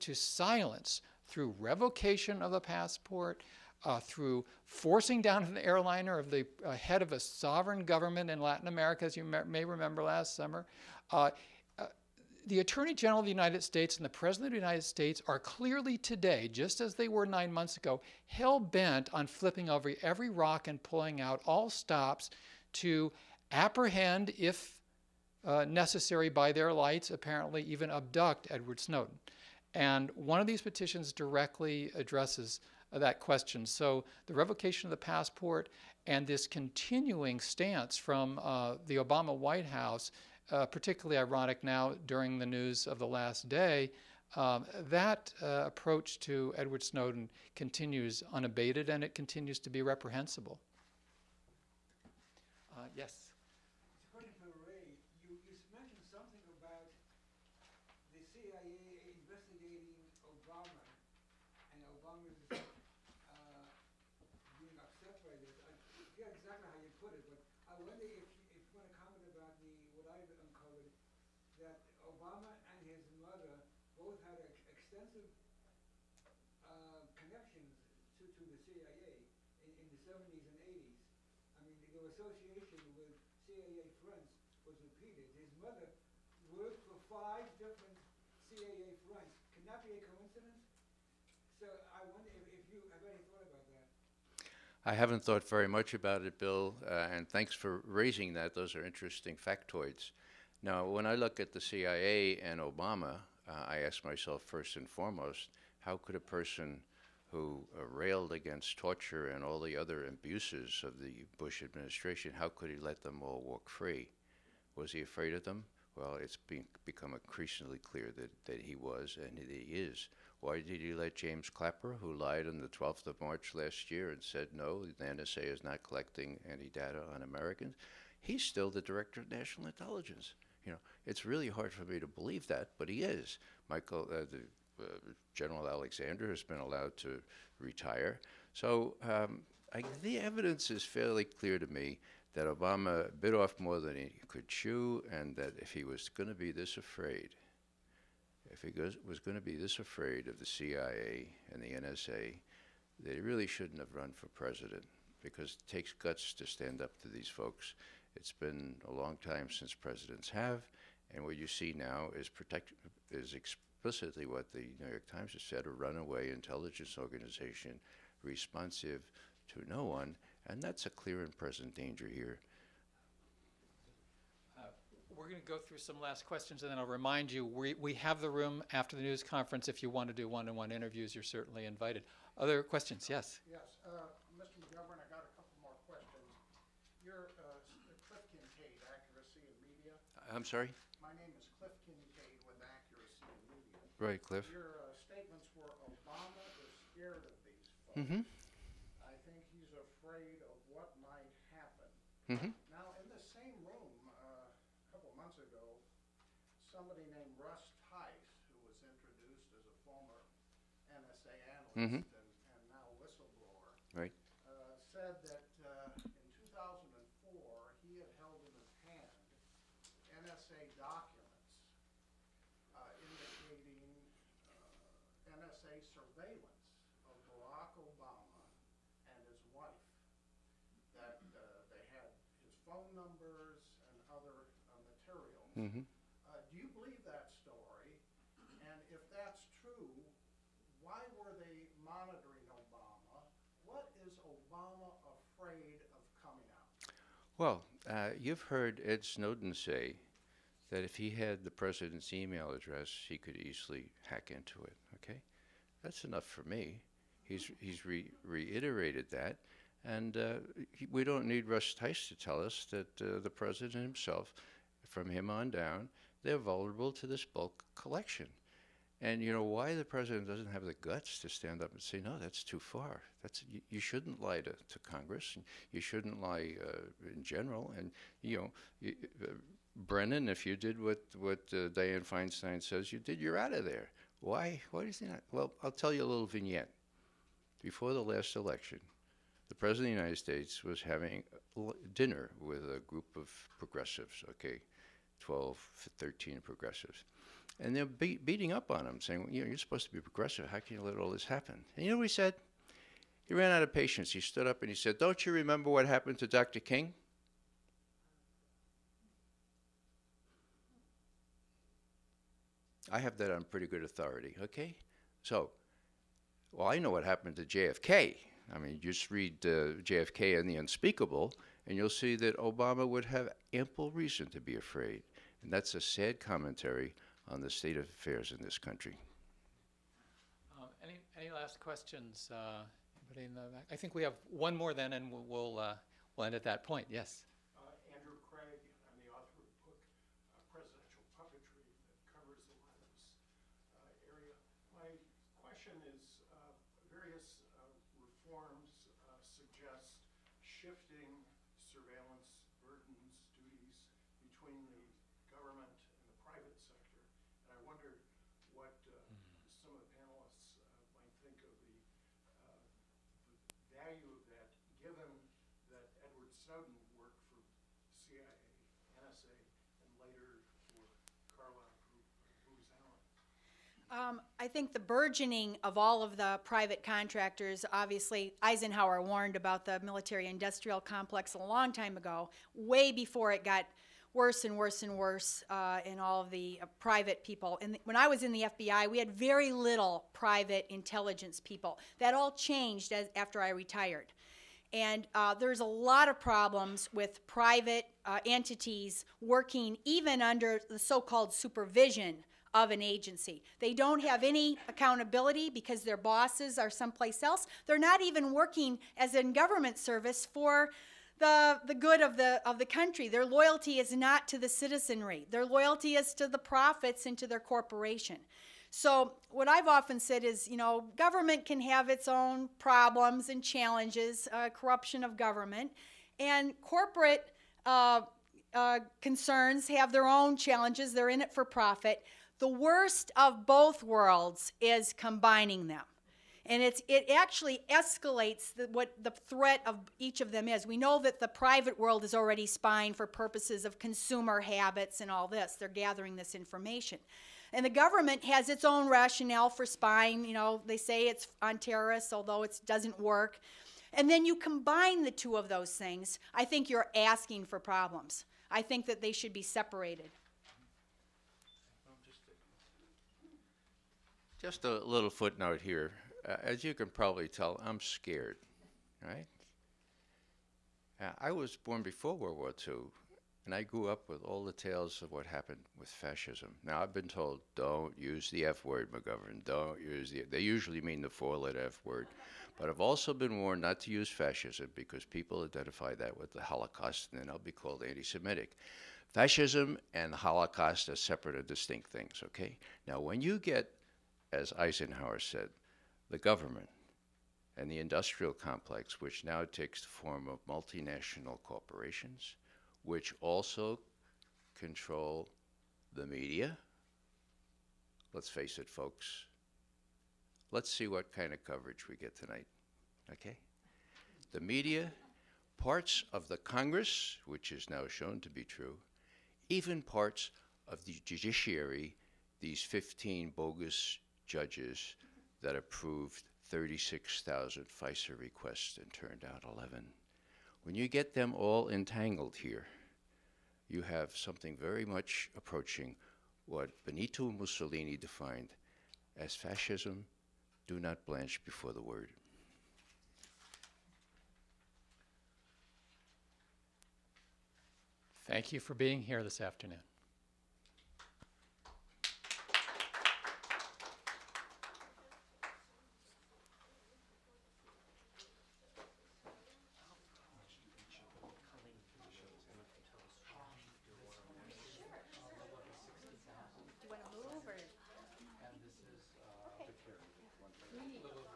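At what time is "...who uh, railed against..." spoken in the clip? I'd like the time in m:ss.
1:47.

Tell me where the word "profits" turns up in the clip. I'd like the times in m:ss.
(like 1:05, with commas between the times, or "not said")
6:56, 7:11.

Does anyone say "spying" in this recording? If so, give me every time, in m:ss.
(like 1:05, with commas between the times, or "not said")
7:22, 7:29.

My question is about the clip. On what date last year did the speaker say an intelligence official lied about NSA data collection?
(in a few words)
12th of March.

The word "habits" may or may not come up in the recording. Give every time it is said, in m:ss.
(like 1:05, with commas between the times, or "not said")
7:24.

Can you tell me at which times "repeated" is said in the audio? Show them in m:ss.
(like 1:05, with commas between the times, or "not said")
1:24.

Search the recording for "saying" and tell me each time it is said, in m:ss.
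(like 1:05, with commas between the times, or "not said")
4:58.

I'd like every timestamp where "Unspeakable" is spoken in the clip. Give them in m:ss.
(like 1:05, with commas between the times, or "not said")
5:20.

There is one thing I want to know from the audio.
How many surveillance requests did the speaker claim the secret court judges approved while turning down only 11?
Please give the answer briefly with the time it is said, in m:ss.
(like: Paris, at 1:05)
36,000, at 8:46.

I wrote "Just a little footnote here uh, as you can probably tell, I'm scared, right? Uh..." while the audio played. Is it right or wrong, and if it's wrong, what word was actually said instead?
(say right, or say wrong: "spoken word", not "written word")
right.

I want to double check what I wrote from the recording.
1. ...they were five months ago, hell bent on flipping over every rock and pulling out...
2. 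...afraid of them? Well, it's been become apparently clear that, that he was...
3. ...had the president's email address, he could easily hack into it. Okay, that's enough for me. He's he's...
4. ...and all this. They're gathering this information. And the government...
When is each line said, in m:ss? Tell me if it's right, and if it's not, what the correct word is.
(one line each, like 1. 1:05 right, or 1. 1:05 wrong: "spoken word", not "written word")
1. 0:16 wrong: "nine", not "five"
2. 1:54 wrong: "increasingly", not "apparently"
3. 4:11 right
4. 7:25 right.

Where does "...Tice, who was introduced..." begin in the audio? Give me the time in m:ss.
3:27.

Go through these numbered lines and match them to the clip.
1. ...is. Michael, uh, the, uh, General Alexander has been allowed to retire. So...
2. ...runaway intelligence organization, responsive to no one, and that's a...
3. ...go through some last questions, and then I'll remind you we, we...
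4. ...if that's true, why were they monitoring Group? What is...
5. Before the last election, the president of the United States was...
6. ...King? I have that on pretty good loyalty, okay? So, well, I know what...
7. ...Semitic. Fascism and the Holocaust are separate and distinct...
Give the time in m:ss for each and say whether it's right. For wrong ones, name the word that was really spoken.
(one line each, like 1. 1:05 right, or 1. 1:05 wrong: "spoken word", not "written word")
1. 2:13 right
2. 2:45 right
3. 2:55 right
4. 3:58 wrong: "Obama", not "Group"
5. 4:47 right
6. 5:06 wrong: "authority", not "loyalty"
7. 8:08 right.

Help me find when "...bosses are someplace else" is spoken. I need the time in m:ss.
6:45.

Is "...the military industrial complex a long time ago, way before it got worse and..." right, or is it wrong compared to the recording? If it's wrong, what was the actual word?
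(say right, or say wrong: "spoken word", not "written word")
right.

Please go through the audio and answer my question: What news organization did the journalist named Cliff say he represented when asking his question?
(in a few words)
Accuracy Media.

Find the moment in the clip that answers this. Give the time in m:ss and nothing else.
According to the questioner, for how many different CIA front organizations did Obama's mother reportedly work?
1:27.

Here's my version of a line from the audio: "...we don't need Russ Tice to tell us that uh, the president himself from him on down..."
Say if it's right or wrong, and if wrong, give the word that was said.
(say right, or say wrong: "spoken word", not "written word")
right.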